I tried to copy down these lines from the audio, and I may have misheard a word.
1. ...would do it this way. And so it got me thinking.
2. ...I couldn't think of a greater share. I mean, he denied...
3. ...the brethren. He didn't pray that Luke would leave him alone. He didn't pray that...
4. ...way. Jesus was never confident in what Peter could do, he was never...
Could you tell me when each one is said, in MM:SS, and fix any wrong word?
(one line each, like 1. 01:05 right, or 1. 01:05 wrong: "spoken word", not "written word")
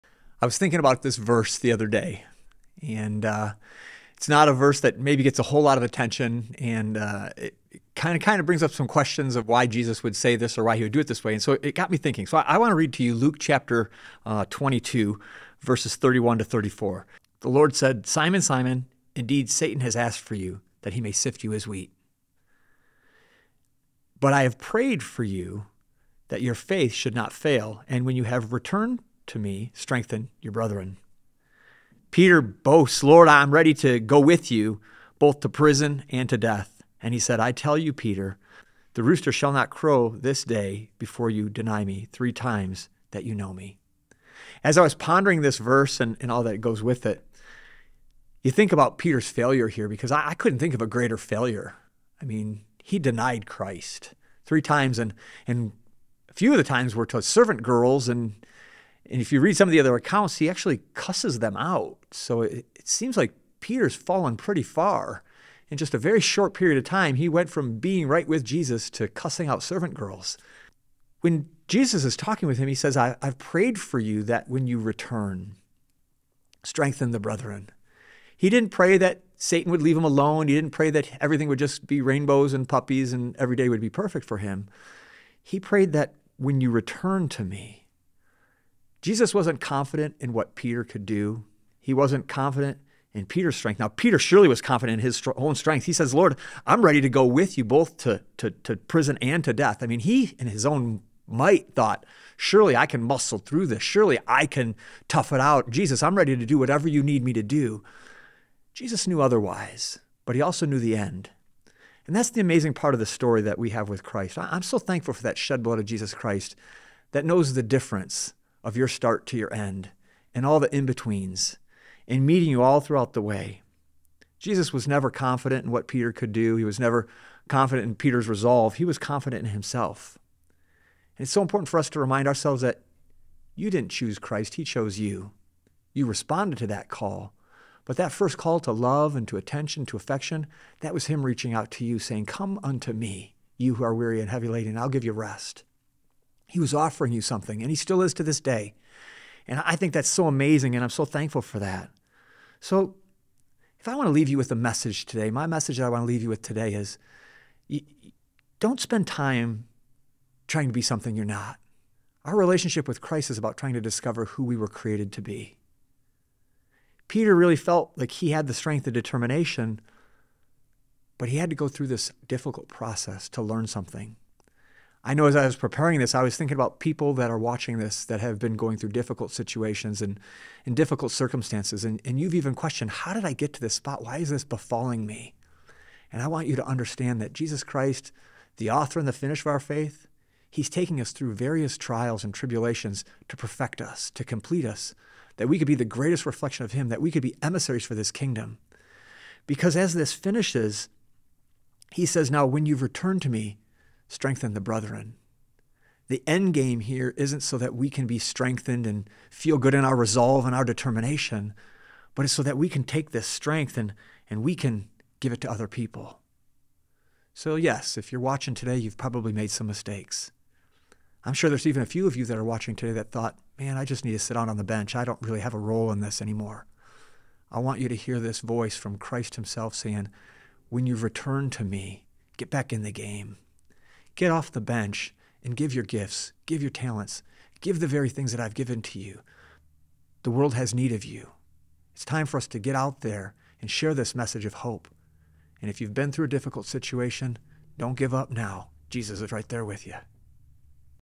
1. 00:10 right
2. 00:50 wrong: "failure", not "share"
3. 01:17 wrong: "Satan", not "Luke"
4. 02:03 right.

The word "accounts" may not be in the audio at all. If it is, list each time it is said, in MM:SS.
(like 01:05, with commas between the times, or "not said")
00:59.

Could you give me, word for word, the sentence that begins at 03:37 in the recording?
So, yes, if you're watching today, you've probably made some mistakes.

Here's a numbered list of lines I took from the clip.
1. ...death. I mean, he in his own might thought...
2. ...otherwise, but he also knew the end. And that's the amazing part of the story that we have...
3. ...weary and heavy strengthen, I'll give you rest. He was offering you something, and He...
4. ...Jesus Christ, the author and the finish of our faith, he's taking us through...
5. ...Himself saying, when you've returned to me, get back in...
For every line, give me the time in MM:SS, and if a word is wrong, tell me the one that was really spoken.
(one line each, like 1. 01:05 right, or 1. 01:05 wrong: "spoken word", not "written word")
1. 01:39 right
2. 01:49 right
3. 02:23 wrong: "laden", not "strengthen"
4. 03:07 right
5. 03:49 right.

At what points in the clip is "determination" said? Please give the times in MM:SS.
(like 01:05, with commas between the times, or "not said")
02:48, 03:30.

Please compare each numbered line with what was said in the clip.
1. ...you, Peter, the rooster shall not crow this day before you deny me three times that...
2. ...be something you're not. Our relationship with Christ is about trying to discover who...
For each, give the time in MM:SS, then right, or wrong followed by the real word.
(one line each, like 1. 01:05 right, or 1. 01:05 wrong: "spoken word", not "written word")
1. 00:37 right
2. 02:40 right.